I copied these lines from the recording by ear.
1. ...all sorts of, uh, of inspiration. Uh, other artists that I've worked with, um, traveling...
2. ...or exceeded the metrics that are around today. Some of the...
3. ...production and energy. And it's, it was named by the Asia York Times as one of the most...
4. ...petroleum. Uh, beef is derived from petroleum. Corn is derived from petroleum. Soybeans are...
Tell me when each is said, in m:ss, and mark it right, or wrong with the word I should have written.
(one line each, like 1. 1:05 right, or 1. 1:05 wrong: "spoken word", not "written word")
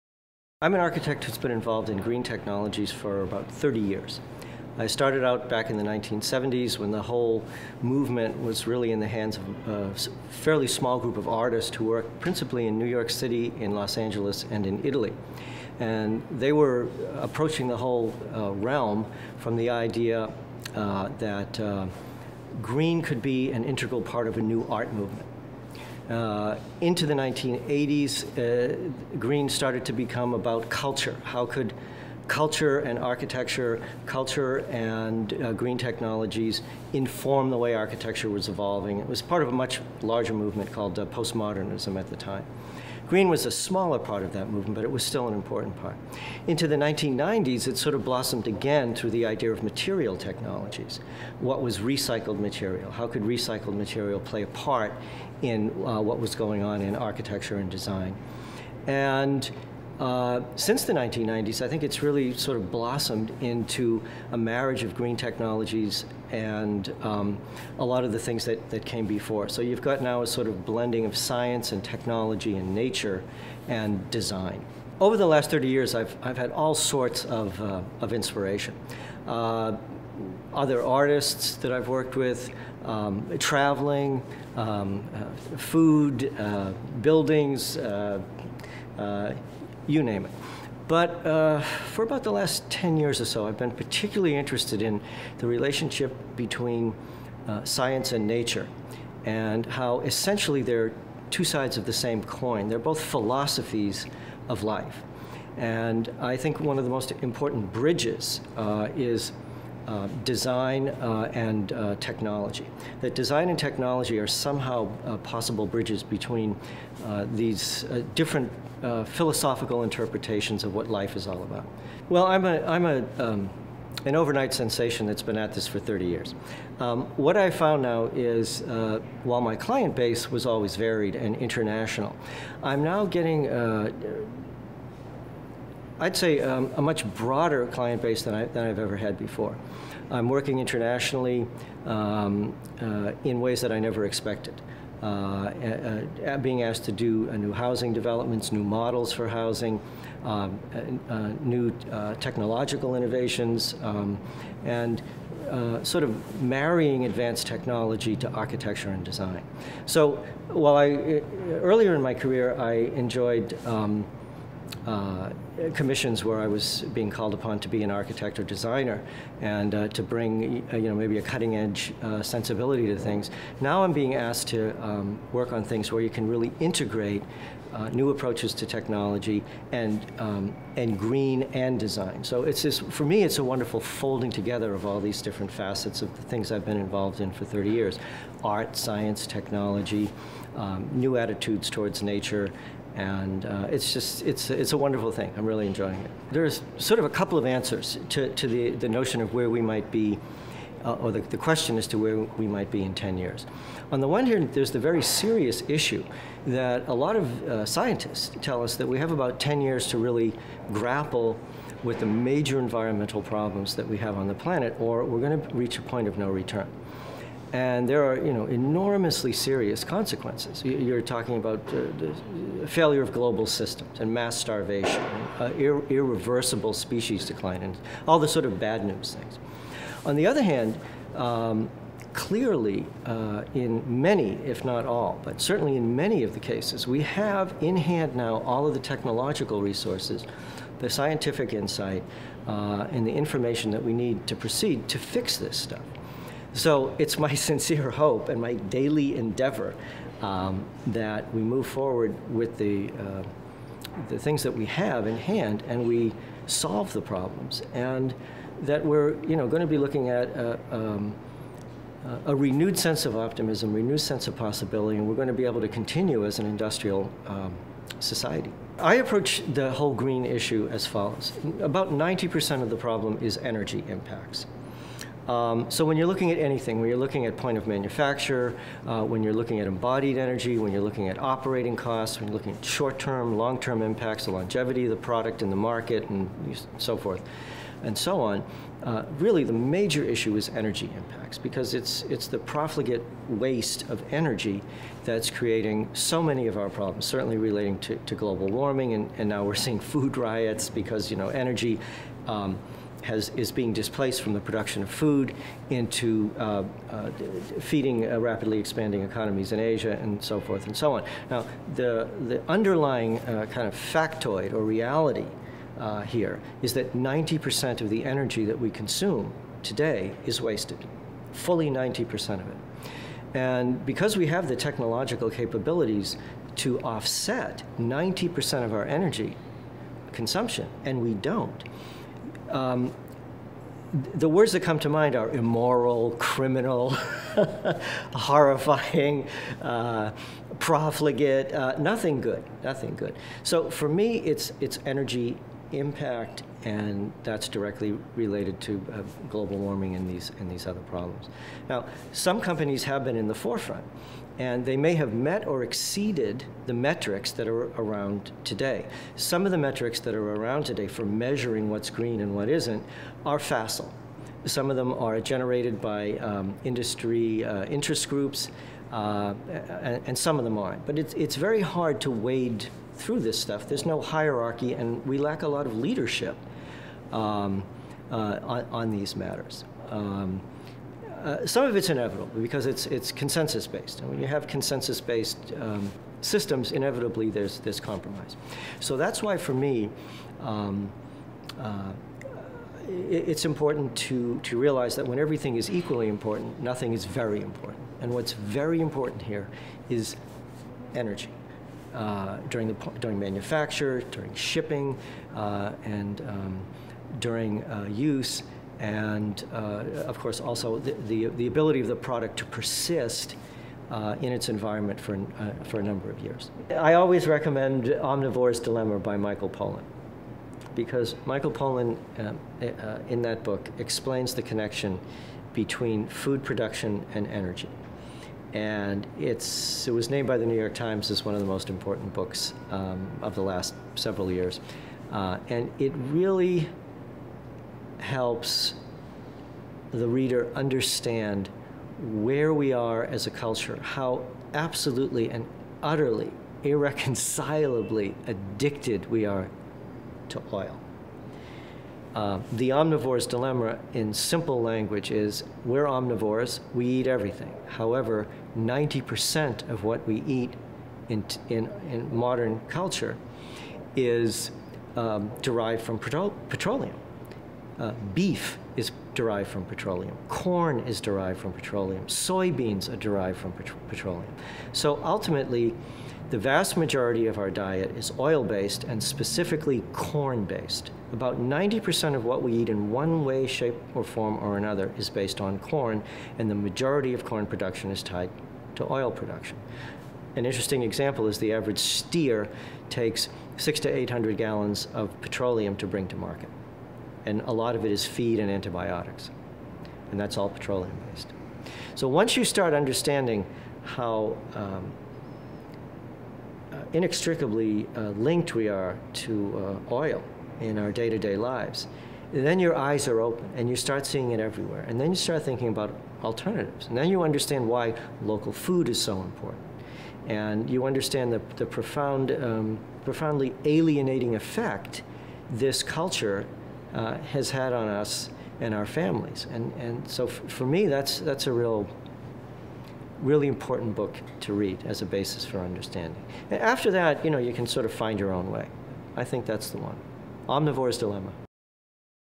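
1. 1:16 right
2. 5:55 right
3. 7:06 wrong: "New", not "Asia"
4. 7:46 right.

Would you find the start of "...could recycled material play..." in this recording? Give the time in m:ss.
0:53.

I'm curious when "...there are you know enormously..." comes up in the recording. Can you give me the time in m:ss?
3:37.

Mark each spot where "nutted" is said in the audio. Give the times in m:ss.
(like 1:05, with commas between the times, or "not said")
not said.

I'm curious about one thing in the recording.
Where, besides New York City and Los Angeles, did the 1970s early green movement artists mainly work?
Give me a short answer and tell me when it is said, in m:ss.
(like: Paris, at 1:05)
Italy, at 0:14.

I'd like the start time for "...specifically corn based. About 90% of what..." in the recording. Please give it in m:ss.
7:59.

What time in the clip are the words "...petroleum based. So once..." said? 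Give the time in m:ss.
8:20.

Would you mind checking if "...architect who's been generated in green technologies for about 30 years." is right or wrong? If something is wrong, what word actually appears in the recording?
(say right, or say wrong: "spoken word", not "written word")
wrong: "involved", not "generated".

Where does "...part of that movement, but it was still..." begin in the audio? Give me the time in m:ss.
0:43.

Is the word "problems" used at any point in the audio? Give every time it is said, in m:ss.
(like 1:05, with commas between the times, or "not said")
3:33, 4:17, 4:32, 4:56, 5:50.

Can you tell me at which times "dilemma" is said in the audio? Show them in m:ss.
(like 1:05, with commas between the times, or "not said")
6:58, 7:33, 9:00.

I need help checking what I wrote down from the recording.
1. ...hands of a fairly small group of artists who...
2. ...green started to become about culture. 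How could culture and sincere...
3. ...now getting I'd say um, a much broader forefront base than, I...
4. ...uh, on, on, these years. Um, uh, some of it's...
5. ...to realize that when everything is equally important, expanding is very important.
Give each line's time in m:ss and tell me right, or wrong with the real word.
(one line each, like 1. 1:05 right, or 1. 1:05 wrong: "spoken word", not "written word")
1. 0:09 right
2. 0:29 wrong: "architecture", not "sincere"
3. 2:12 wrong: "client", not "forefront"
4. 6:18 wrong: "matters", not "years"
5. 6:34 wrong: "nothing", not "expanding".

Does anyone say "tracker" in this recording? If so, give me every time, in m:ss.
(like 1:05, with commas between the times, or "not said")
not said.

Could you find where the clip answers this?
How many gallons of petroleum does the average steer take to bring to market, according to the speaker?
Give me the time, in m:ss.
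8:13.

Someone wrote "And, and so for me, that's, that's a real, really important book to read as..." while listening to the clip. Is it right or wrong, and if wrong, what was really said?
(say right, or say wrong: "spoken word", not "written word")
right.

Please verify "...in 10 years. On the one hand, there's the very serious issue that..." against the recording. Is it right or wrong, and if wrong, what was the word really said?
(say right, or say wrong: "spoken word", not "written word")
right.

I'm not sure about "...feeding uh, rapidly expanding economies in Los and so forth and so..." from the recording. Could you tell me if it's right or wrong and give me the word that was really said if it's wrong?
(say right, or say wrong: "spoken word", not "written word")
wrong: "Asia", not "Los".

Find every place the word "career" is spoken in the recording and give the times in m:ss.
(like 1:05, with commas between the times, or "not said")
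2:42.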